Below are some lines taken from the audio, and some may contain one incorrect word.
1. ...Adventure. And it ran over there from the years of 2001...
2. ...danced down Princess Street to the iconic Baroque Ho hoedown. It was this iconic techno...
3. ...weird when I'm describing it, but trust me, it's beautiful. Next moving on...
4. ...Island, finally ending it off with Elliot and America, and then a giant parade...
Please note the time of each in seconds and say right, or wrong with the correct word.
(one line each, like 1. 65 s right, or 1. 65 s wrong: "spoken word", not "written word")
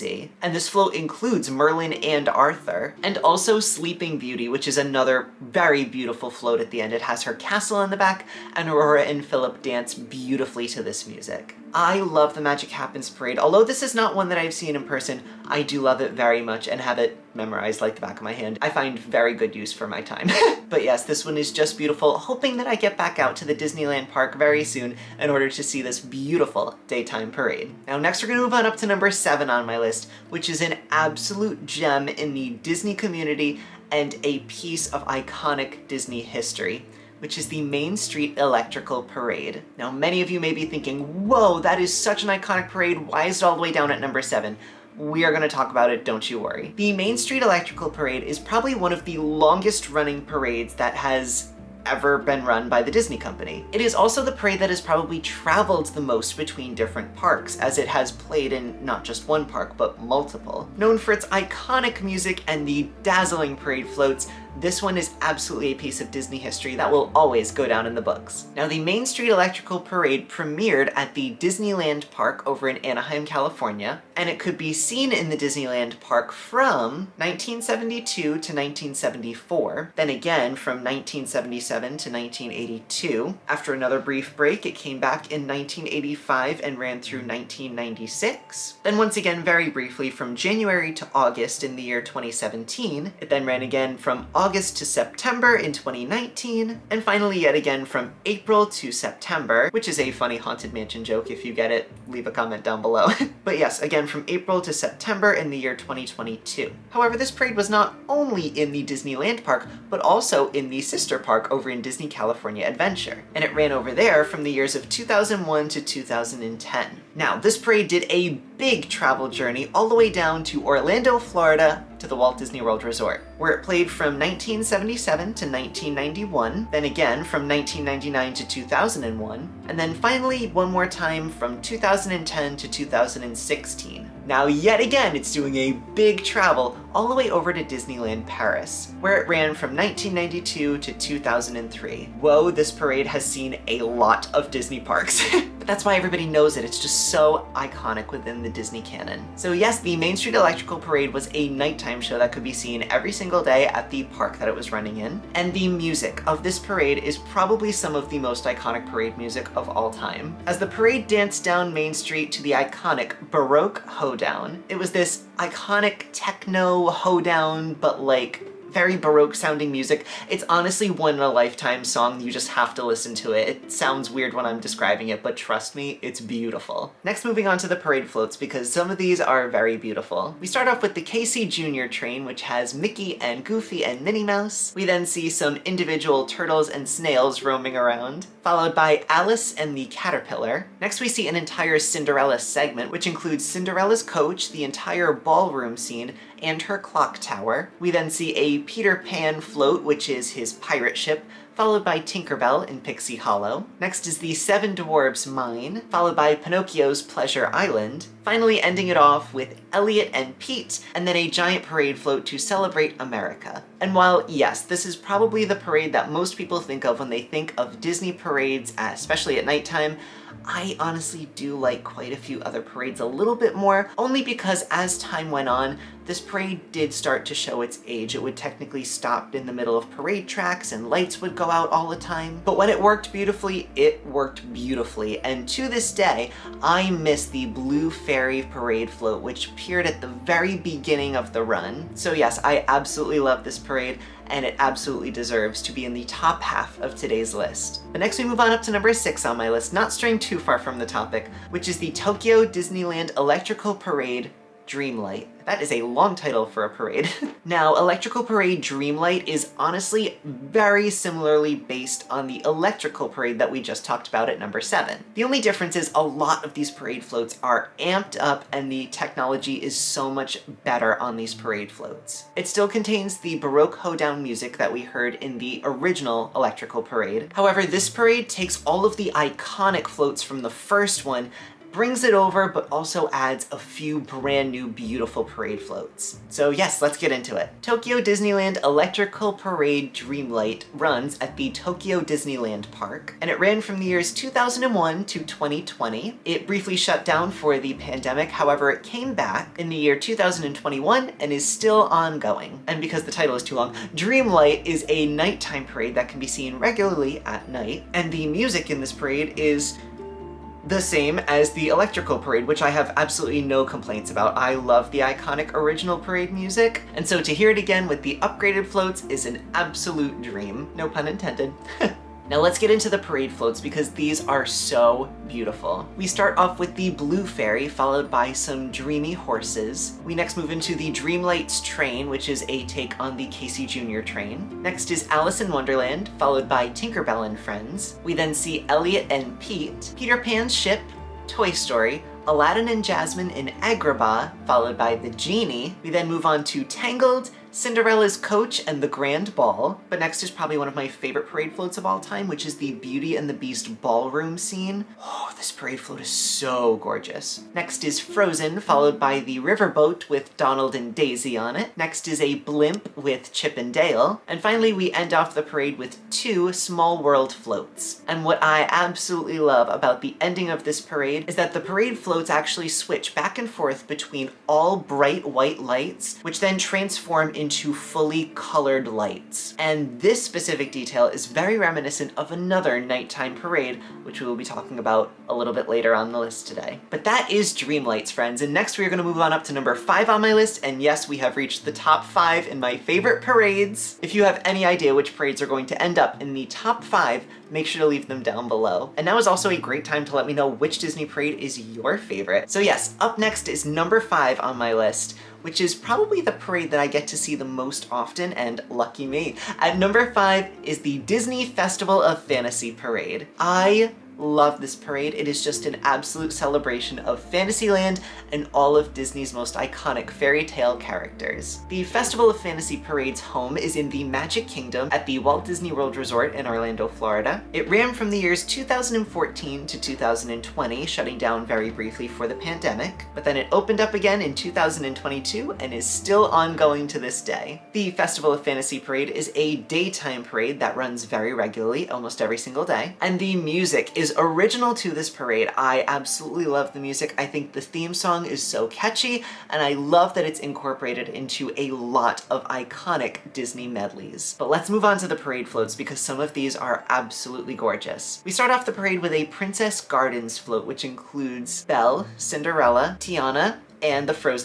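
1. 112 s right
2. 161 s wrong: "Main", not "Princess"
3. 174 s right
4. 207 s wrong: "Pete", not "America".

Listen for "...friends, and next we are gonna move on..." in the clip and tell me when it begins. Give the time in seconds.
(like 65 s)
388 s.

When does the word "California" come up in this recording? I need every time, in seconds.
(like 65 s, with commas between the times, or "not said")
73 s, 112 s.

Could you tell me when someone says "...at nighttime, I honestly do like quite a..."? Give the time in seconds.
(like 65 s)
219 s.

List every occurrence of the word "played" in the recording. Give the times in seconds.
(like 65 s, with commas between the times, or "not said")
58 s, 123 s.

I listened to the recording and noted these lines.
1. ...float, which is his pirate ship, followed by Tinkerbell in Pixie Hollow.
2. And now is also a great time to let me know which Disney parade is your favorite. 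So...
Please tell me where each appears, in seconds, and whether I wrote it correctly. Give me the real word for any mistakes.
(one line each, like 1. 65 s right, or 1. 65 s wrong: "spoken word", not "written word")
1. 199 s right
2. 398 s right.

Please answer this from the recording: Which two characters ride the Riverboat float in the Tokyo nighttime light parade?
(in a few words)
Donald and Daisy.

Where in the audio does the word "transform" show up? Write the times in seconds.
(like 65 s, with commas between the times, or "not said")
376 s.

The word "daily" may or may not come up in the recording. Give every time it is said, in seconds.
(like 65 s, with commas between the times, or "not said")
not said.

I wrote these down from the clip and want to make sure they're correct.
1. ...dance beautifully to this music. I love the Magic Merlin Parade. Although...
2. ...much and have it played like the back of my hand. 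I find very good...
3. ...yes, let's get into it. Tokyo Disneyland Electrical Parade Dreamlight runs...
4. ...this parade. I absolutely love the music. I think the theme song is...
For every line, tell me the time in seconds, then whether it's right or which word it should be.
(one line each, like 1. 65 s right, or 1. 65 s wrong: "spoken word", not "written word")
1. 9 s wrong: "Happens", not "Merlin"
2. 16 s wrong: "memorized", not "played"
3. 286 s right
4. 444 s right.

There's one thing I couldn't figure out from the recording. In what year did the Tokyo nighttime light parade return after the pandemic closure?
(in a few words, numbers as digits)
2021.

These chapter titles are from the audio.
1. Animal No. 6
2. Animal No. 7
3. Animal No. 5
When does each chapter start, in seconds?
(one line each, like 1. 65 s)
1. 247 s
2. 27 s
3. 388 s.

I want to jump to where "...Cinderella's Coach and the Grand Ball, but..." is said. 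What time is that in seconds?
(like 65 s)
347 s.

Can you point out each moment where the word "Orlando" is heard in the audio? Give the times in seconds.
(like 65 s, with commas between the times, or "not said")
120 s, 426 s.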